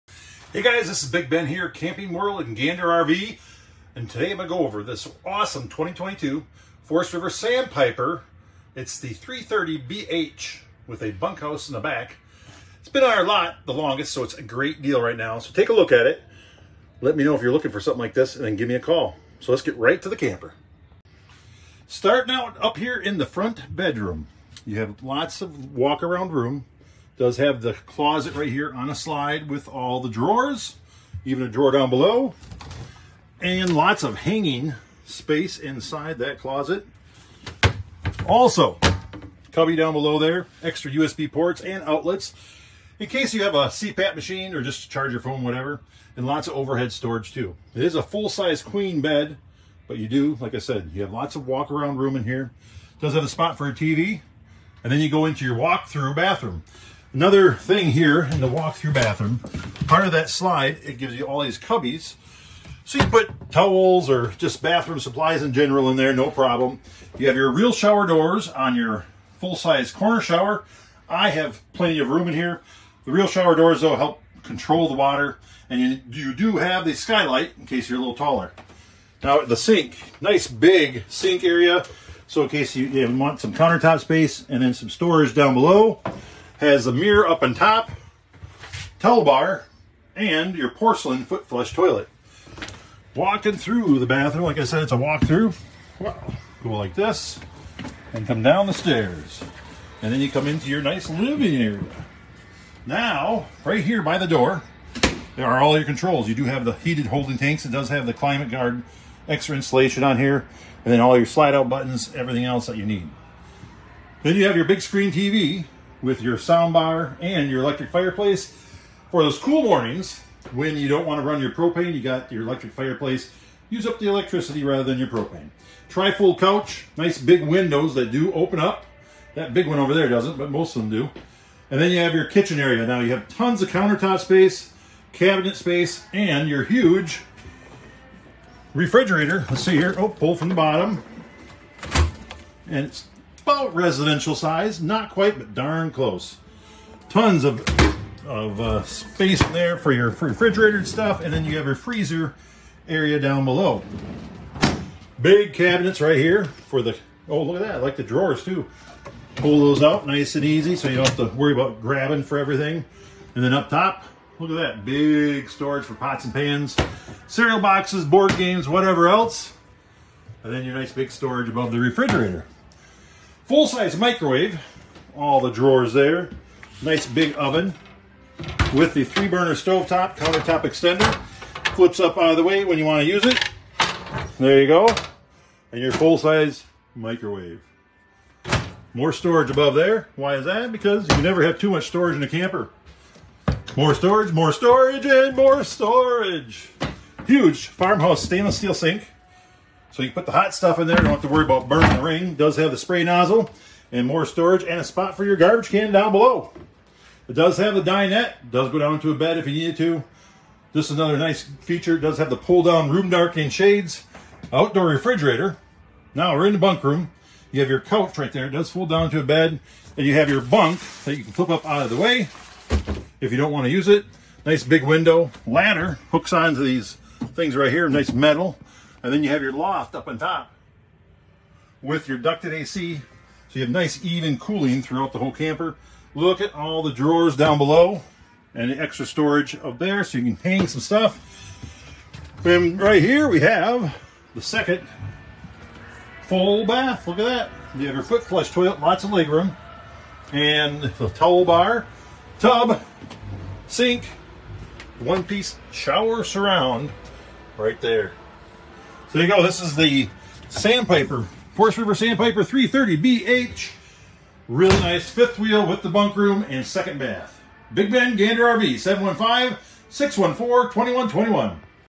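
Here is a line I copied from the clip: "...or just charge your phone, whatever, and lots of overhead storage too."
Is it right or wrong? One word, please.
right.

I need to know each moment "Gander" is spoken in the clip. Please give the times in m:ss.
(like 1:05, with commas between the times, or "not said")
0:02, 4:28.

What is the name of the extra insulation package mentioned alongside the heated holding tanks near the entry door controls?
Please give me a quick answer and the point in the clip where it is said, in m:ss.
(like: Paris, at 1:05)
Climate guard, at 1:48.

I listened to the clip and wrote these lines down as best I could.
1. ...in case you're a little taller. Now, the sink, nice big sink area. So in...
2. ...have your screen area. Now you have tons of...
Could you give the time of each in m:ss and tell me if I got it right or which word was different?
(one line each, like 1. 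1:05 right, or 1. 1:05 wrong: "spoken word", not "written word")
1. 1:17 right
2. 2:11 wrong: "kitchen", not "screen".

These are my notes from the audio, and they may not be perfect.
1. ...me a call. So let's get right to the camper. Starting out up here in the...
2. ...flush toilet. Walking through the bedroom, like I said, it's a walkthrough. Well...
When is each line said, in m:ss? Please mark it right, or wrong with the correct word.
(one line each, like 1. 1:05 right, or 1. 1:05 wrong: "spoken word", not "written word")
1. 0:18 right
2. 1:31 wrong: "bathroom", not "bedroom".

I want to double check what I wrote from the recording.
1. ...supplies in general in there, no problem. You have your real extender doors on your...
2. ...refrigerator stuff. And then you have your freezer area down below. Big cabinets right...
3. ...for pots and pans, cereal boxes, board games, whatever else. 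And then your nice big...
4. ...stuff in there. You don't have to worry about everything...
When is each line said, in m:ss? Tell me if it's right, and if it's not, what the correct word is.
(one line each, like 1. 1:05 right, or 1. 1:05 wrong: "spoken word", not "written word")
1. 1:05 wrong: "shower", not "extender"
2. 2:30 right
3. 2:45 right
4. 3:20 wrong: "burning", not "everything".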